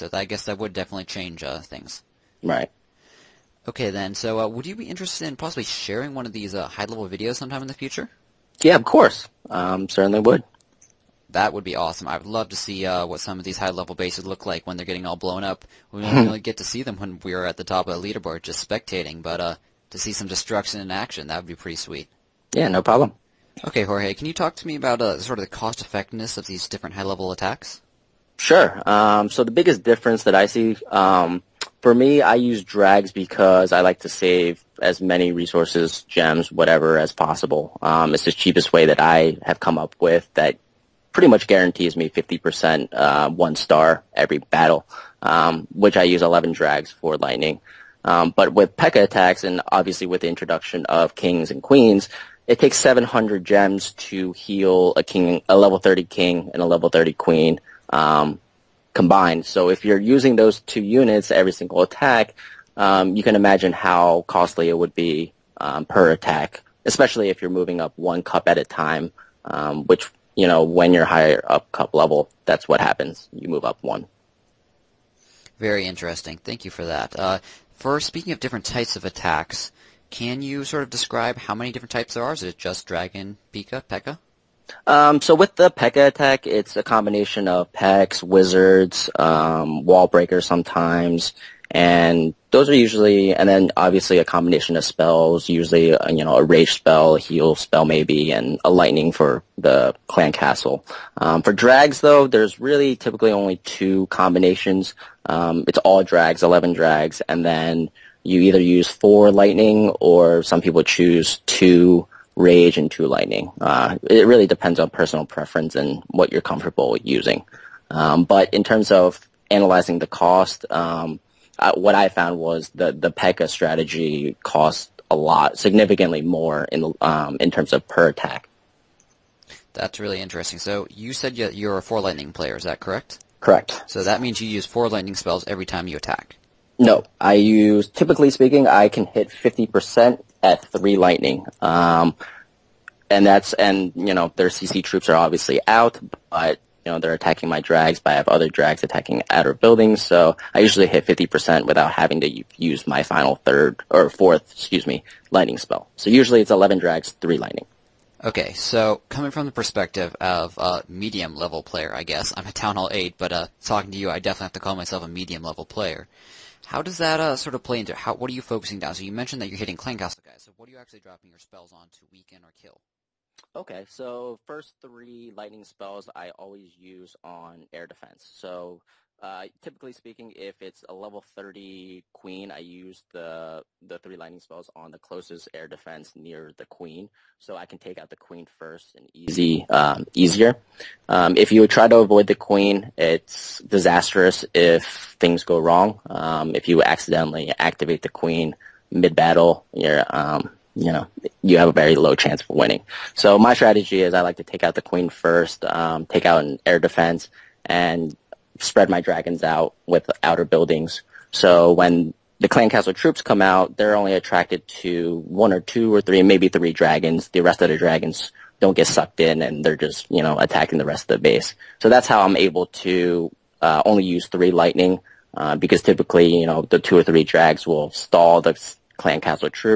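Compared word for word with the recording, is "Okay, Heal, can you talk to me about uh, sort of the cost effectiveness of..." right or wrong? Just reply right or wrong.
wrong.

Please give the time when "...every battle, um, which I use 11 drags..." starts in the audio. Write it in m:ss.
0:44.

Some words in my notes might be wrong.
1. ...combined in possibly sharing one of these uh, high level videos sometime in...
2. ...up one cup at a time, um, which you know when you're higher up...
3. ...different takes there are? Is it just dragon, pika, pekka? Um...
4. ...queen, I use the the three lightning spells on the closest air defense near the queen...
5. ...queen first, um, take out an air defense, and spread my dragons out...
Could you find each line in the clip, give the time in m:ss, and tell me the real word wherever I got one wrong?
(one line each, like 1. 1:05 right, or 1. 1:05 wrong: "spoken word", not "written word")
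1. 0:04 wrong: "interested", not "combined"
2. 1:07 right
3. 1:21 wrong: "types", not "takes"
4. 3:02 right
5. 3:24 right.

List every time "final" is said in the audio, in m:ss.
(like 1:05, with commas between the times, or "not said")
2:33.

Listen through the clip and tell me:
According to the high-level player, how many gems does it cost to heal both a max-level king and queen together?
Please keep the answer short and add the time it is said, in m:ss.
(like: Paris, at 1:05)
700, at 0:52.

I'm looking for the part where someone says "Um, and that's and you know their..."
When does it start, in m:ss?
2:21.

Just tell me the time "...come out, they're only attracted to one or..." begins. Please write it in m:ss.
3:33.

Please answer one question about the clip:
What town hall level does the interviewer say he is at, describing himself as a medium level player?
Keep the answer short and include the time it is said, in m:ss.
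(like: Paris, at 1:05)
town hall eight, at 2:42.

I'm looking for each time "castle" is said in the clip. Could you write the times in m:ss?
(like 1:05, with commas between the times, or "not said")
1:40, 2:49, 3:32, 3:49.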